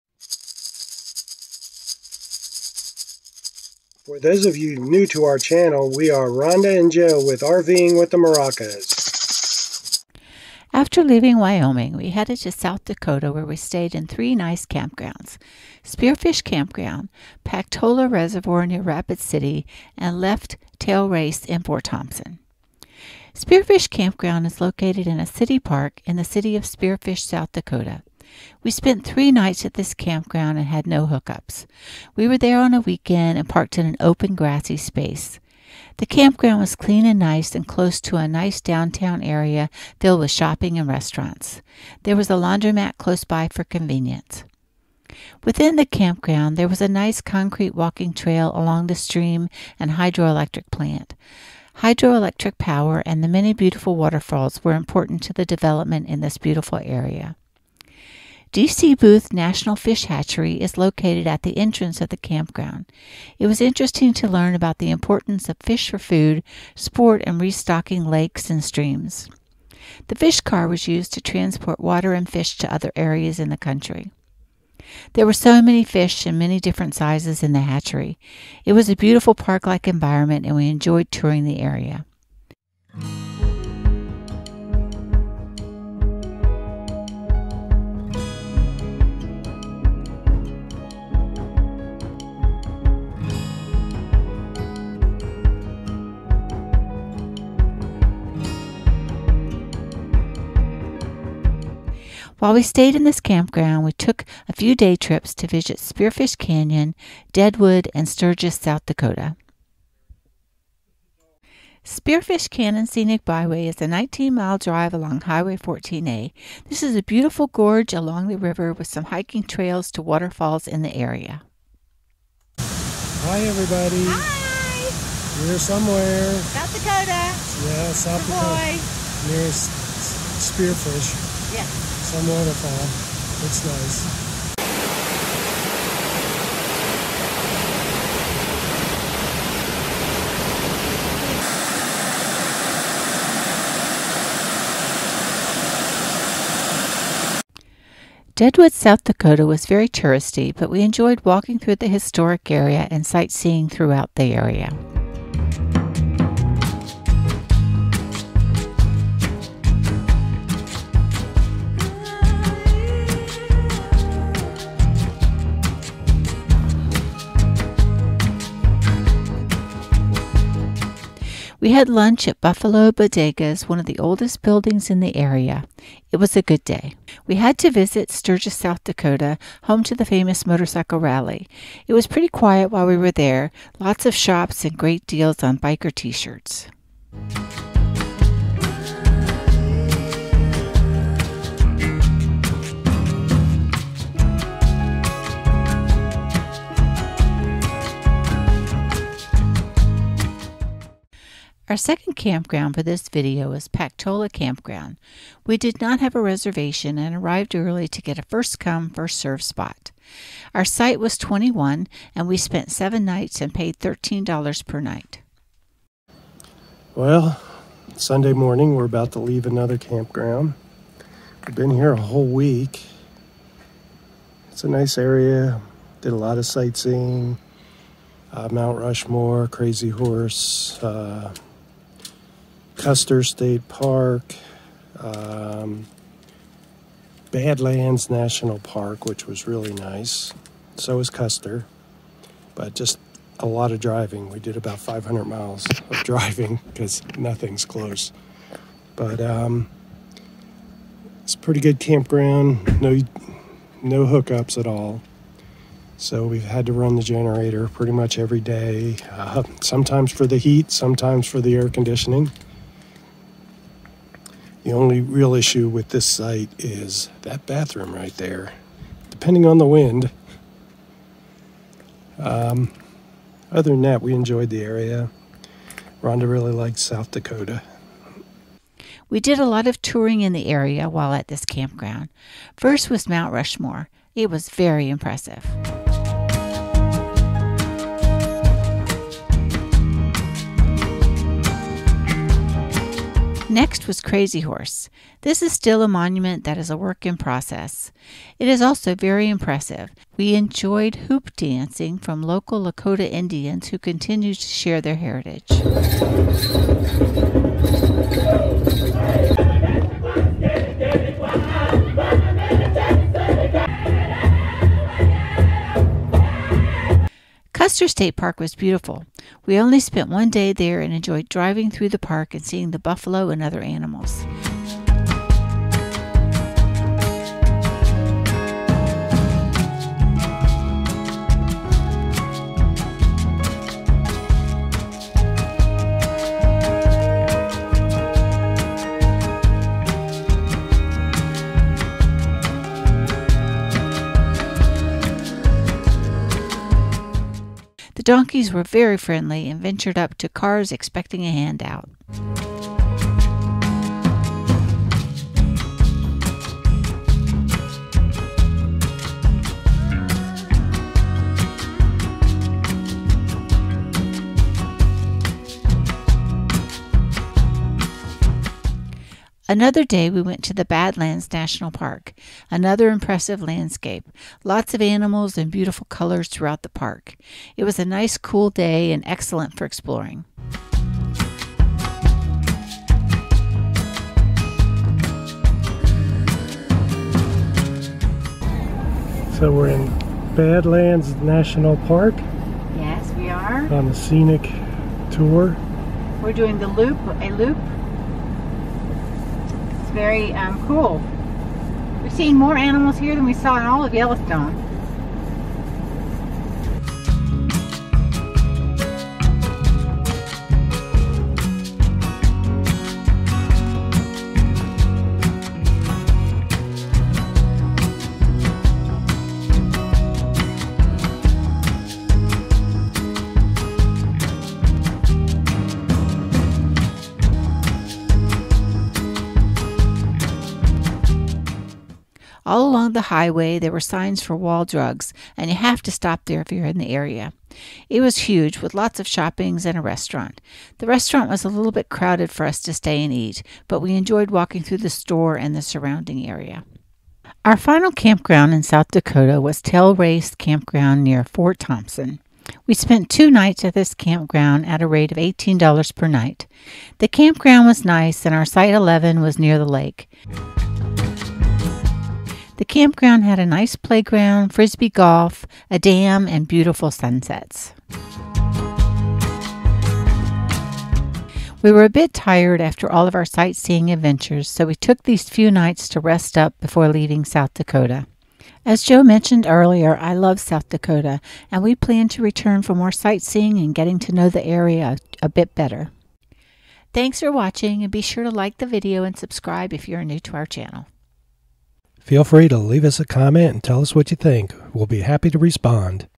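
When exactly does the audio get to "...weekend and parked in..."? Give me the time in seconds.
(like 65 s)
32 s.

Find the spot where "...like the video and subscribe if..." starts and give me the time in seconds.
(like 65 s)
488 s.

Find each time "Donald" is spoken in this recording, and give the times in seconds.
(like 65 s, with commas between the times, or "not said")
not said.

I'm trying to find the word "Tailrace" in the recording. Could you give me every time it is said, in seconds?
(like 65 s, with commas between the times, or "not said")
20 s, 449 s.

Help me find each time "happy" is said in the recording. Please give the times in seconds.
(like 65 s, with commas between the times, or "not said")
495 s.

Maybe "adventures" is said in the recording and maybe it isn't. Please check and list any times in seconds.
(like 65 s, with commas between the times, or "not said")
473 s.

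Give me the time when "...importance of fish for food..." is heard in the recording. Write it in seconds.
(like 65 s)
64 s.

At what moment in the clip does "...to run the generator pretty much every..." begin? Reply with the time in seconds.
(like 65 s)
256 s.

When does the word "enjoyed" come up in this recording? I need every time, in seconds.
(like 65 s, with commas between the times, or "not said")
80 s, 150 s, 274 s, 300 s, 320 s, 443 s.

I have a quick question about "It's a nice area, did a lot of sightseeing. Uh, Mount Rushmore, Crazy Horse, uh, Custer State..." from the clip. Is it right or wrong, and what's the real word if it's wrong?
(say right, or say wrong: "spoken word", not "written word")
right.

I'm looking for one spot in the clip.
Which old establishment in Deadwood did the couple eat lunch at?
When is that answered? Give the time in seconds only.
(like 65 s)
172 s.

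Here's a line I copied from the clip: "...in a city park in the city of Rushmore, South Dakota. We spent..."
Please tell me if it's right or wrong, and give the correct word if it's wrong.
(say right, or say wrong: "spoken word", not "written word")
wrong: "Spearfish", not "Rushmore".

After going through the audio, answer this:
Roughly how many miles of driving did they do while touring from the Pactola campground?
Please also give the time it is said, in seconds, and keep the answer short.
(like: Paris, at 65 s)
500, at 244 s.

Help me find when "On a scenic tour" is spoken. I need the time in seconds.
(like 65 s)
393 s.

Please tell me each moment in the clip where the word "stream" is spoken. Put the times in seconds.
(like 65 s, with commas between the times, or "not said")
48 s, 68 s.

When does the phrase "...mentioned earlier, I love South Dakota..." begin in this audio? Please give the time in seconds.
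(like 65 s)
479 s.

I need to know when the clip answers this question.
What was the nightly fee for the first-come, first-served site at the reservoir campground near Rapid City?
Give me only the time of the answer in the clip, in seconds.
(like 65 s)
213 s.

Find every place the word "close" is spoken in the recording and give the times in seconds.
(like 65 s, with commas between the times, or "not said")
37 s, 42 s, 247 s.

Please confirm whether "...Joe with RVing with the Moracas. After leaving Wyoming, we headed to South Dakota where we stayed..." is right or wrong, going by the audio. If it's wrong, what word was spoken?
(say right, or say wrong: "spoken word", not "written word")
right.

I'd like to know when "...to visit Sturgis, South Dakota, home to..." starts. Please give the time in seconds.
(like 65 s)
177 s.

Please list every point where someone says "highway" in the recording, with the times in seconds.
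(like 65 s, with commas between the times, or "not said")
115 s, 433 s.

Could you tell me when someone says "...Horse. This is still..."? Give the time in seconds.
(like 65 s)
294 s.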